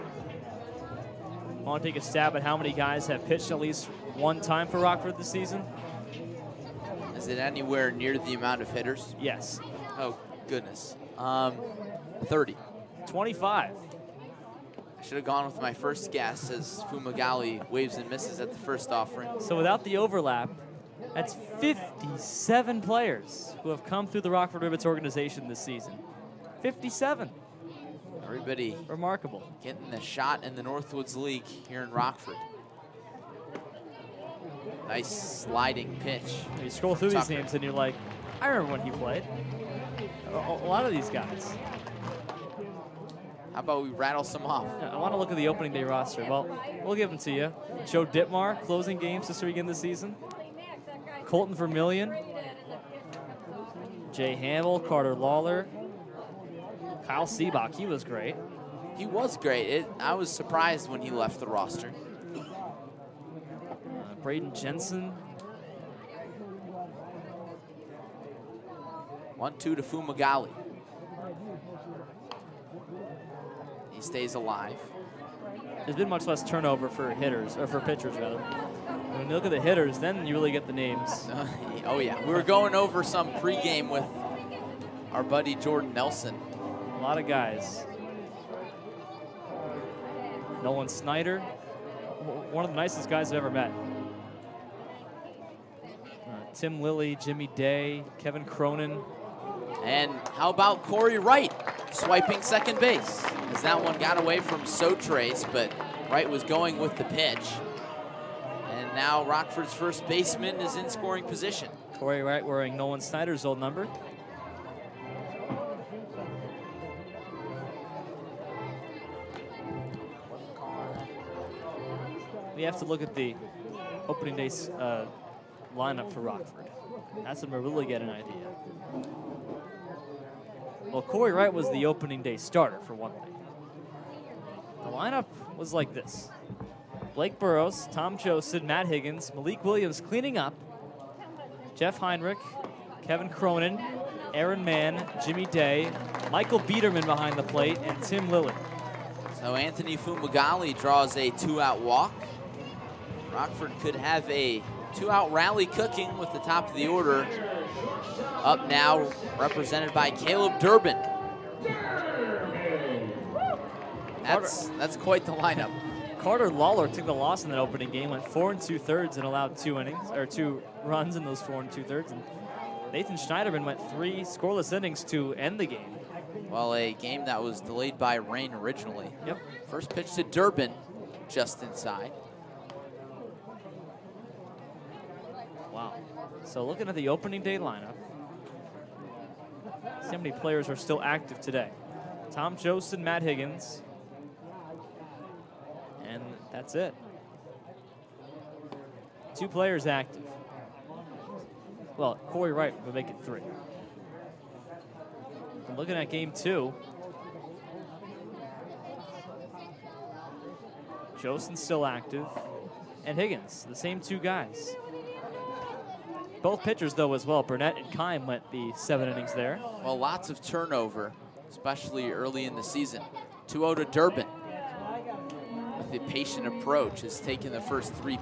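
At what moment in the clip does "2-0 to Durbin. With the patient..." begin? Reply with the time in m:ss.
3:43.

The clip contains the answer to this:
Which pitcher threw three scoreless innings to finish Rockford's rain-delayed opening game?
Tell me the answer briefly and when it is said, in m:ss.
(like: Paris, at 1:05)
Nathan Schneiderman, at 2:52.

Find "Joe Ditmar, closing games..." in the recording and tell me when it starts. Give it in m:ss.
0:47.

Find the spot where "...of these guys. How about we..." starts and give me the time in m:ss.
0:40.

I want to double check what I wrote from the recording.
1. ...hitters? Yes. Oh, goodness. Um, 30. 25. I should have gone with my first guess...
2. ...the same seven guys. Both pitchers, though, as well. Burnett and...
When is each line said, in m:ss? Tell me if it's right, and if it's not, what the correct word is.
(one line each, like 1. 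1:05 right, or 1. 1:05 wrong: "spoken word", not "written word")
1. 0:08 right
2. 3:33 wrong: "two", not "seven".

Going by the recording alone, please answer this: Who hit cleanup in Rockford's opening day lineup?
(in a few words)
Malik Williams.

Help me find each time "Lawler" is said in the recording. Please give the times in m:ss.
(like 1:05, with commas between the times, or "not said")
0:55, 2:46.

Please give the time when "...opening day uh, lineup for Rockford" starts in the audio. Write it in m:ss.
2:04.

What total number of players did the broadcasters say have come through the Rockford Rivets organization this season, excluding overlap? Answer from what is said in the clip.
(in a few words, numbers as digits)
57.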